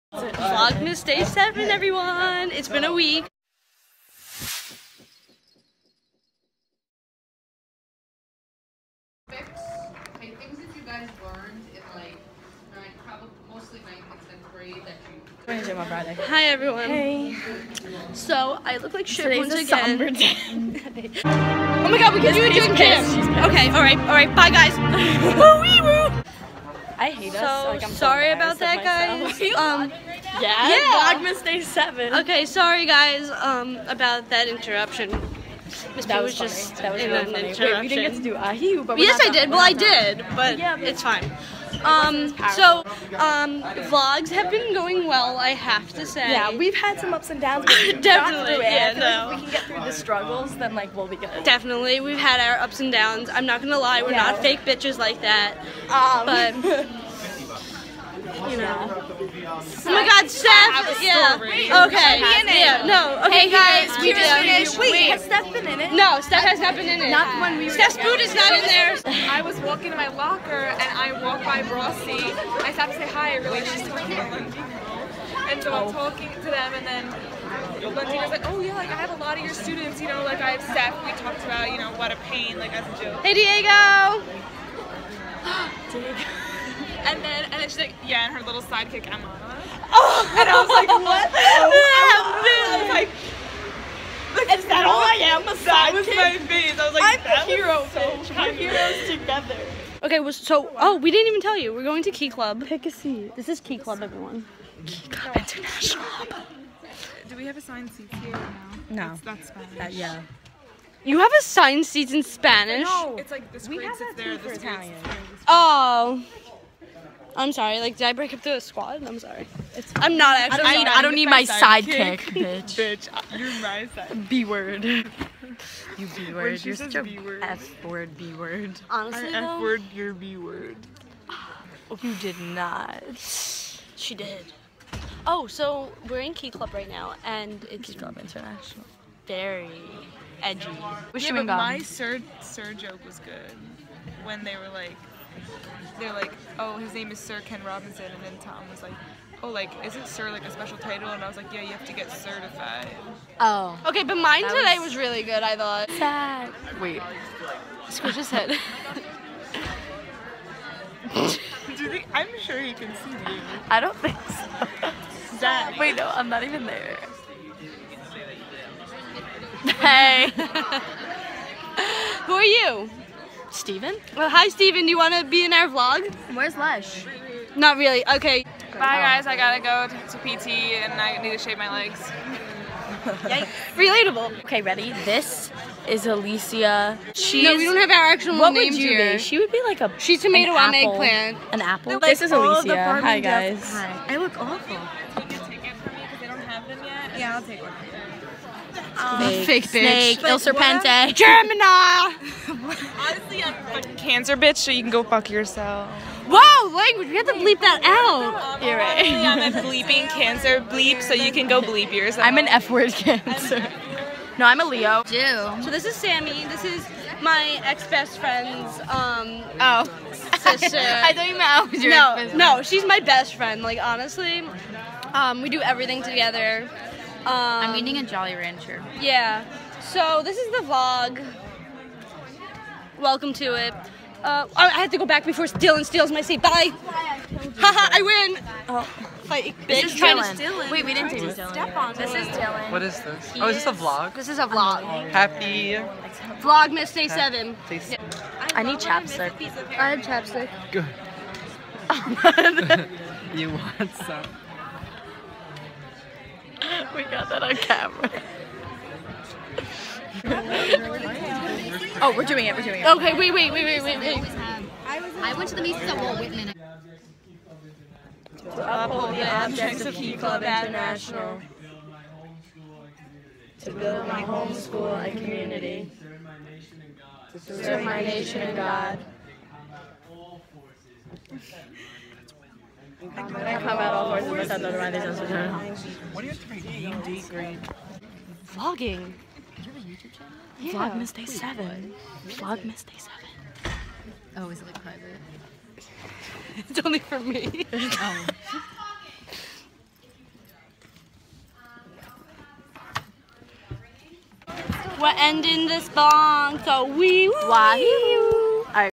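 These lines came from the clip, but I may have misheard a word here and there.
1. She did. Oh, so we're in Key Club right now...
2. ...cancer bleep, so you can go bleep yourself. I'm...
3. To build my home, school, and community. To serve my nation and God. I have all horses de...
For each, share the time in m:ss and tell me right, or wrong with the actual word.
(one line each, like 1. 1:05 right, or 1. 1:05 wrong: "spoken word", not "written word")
1. 2:13 right
2. 3:30 right
3. 4:33 right.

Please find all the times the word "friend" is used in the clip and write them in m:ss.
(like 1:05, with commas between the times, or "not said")
3:38, 3:43.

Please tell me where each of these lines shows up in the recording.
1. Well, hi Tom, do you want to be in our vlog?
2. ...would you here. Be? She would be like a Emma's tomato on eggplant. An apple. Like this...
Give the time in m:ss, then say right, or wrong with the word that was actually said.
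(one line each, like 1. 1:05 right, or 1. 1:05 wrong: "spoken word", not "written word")
1. 2:54 wrong: "Steven", not "Tom"
2. 3:08 wrong: "She", not "Emma".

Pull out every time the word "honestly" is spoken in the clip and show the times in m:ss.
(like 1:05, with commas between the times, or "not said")
2:08, 3:22, 3:43.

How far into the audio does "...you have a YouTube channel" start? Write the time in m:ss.
4:49.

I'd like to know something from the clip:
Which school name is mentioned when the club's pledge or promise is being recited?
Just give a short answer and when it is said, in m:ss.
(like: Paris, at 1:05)
Walt Whitman, at 4:26.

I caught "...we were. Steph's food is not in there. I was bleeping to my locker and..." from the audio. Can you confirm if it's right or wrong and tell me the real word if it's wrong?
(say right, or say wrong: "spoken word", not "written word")
wrong: "walking", not "bleeping".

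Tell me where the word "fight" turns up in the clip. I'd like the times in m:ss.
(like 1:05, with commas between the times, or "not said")
3:59.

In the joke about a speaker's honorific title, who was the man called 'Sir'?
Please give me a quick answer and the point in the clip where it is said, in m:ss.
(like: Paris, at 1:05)
Sir Ken Robinson, at 2:27.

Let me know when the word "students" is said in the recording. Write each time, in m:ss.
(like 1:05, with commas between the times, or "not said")
1:19.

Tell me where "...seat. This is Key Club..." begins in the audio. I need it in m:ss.
1:42.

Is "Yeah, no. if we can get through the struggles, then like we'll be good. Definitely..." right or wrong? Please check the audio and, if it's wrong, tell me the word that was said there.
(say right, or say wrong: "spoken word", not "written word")
right.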